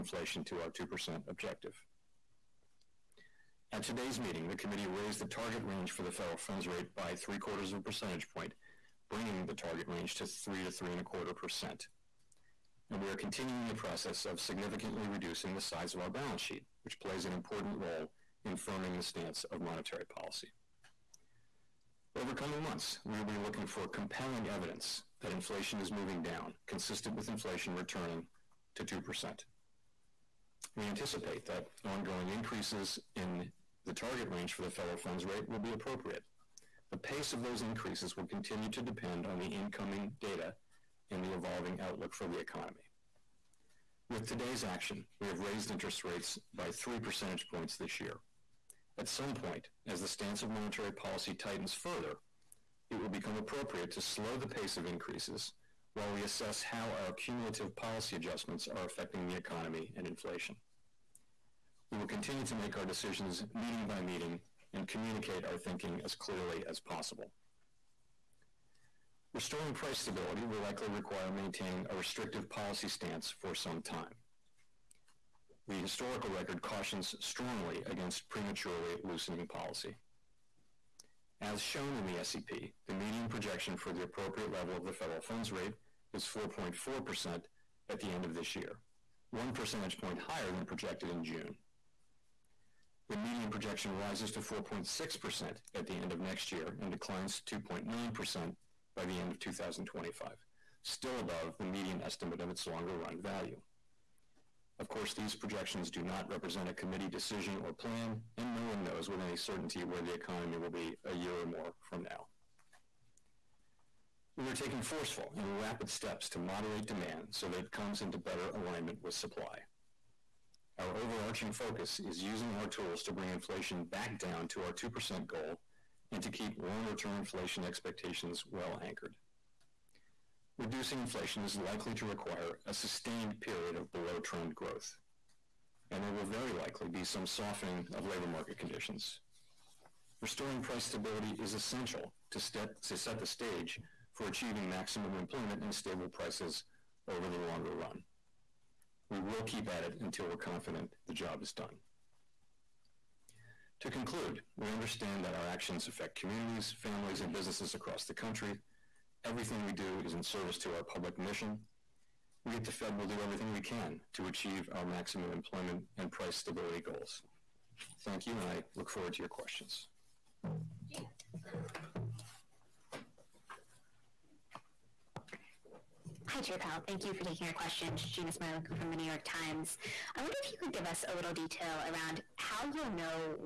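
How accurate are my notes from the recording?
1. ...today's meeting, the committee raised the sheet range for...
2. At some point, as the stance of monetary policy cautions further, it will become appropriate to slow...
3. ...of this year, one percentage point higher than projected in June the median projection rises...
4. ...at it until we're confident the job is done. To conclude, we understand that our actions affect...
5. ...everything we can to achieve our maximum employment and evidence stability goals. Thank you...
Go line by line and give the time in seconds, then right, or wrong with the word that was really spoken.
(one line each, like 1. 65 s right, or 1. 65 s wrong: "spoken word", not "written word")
1. 3 s wrong: "target", not "sheet"
2. 48 s wrong: "tightens", not "cautions"
3. 88 s right
4. 149 s right
5. 163 s wrong: "price", not "evidence".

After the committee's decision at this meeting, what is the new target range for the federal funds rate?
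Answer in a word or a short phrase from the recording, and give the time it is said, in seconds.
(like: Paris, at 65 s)
3% to 3.25%, at 10 s.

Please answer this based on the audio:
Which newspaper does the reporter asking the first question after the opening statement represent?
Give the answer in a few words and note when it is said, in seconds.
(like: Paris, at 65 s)
The New York Times, at 178 s.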